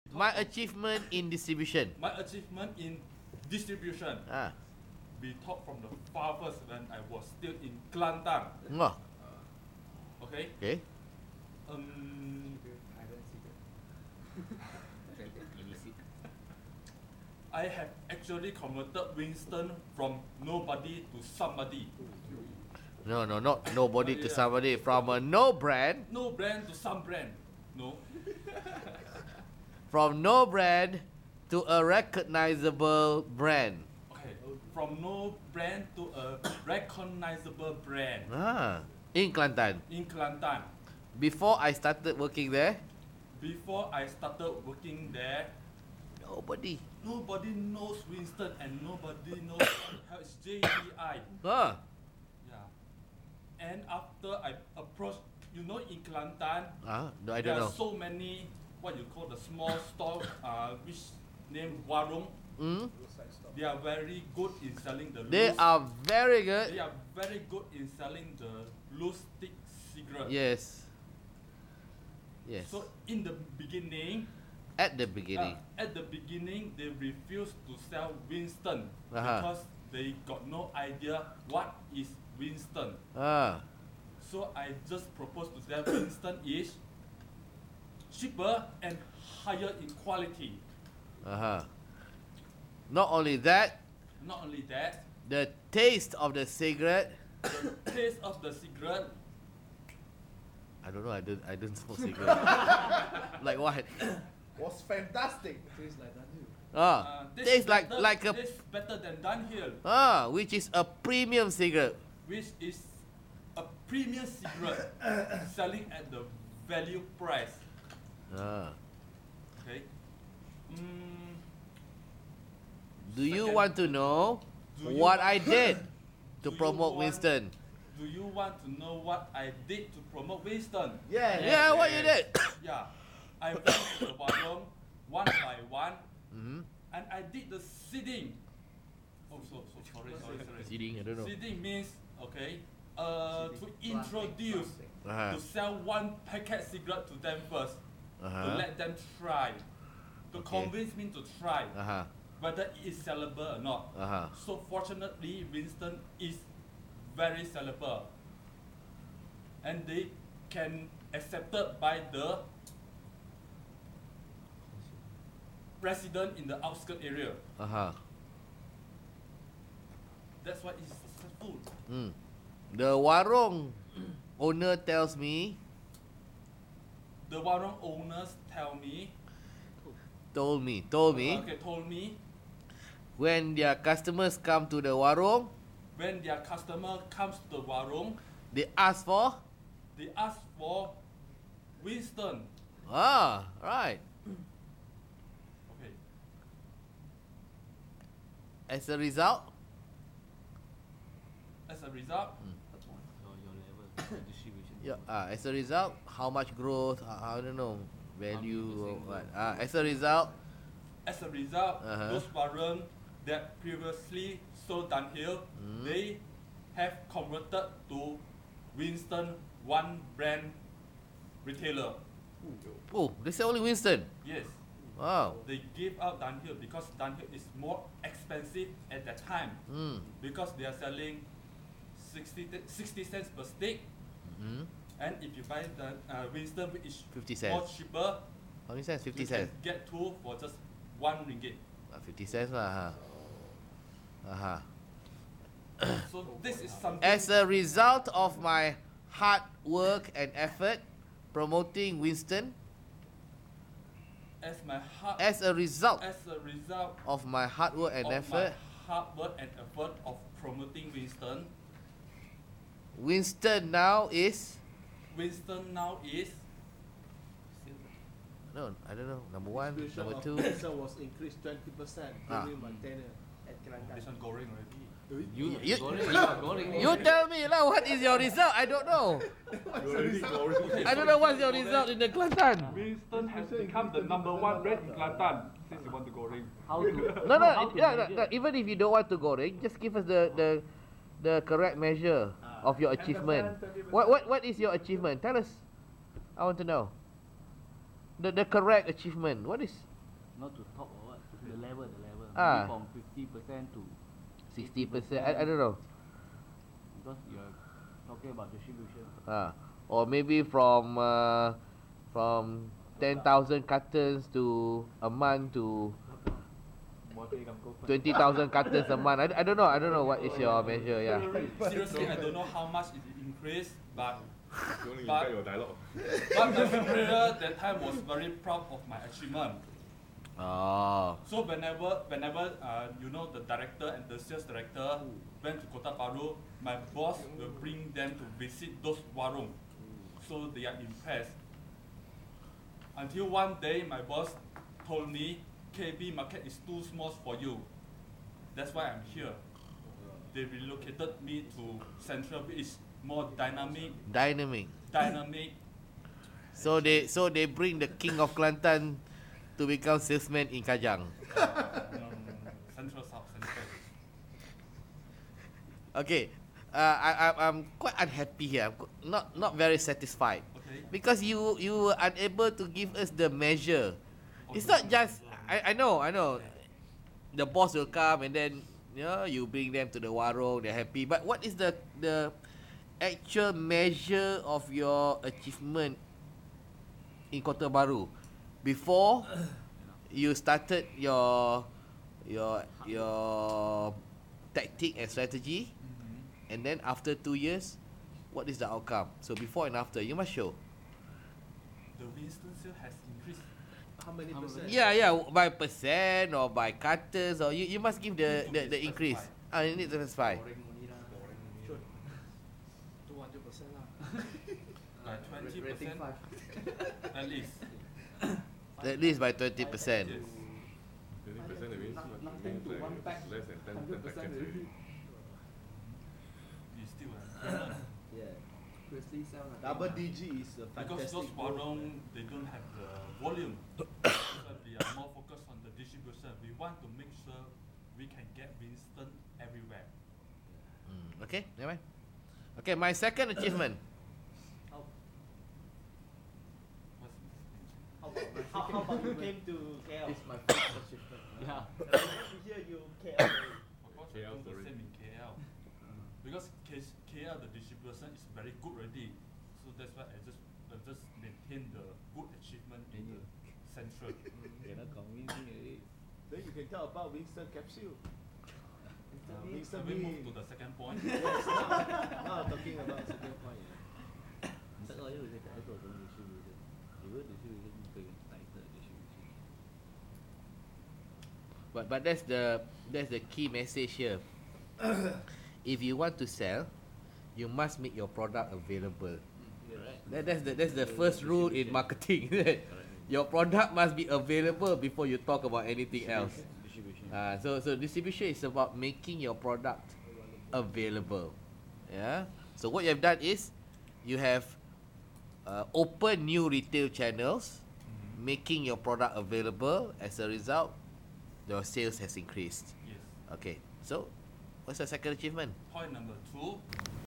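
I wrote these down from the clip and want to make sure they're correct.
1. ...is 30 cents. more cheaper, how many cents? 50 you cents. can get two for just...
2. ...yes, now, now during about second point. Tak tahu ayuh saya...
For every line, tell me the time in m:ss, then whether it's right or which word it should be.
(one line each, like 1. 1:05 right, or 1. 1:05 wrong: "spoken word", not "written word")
1. 3:56 wrong: "50", not "30"
2. 7:51 wrong: "talking", not "during".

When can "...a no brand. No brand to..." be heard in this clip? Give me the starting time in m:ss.
0:25.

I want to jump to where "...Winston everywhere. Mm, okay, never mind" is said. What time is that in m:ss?
7:18.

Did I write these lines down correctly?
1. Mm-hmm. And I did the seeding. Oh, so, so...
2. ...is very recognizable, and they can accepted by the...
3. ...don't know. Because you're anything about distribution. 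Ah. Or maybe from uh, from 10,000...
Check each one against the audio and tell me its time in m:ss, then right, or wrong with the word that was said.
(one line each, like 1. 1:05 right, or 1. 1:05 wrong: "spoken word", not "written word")
1. 2:16 right
2. 2:36 wrong: "sellable", not "recognizable"
3. 5:05 wrong: "talking", not "anything".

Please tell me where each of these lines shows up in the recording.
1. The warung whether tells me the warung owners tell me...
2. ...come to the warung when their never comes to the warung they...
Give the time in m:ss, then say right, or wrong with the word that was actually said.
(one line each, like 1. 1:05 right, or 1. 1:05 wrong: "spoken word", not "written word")
1. 2:52 wrong: "owner", not "whether"
2. 3:04 wrong: "customer", not "never".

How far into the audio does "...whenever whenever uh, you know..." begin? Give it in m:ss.
5:31.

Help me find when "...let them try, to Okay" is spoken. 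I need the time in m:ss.
2:28.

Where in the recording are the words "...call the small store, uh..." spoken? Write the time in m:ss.
0:59.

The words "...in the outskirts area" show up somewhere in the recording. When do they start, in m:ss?
2:46.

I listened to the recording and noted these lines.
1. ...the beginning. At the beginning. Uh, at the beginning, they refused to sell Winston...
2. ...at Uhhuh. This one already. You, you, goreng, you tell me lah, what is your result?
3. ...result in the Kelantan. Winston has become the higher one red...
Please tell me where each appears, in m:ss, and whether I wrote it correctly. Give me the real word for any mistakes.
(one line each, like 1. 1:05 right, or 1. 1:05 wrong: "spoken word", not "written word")
1. 1:13 right
2. 4:33 wrong: "Kelantan", not "Uhhuh"
3. 4:41 wrong: "number", not "higher".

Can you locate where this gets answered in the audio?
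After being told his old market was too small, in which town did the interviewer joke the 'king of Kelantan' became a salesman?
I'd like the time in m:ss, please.
6:00.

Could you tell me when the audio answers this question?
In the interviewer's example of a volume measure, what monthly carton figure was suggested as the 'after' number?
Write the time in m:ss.
5:17.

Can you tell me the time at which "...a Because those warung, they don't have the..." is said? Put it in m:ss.
7:10.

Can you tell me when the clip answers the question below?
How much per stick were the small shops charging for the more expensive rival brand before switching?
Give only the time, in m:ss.
3:52.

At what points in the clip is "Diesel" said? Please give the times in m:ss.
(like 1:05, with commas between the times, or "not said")
4:30.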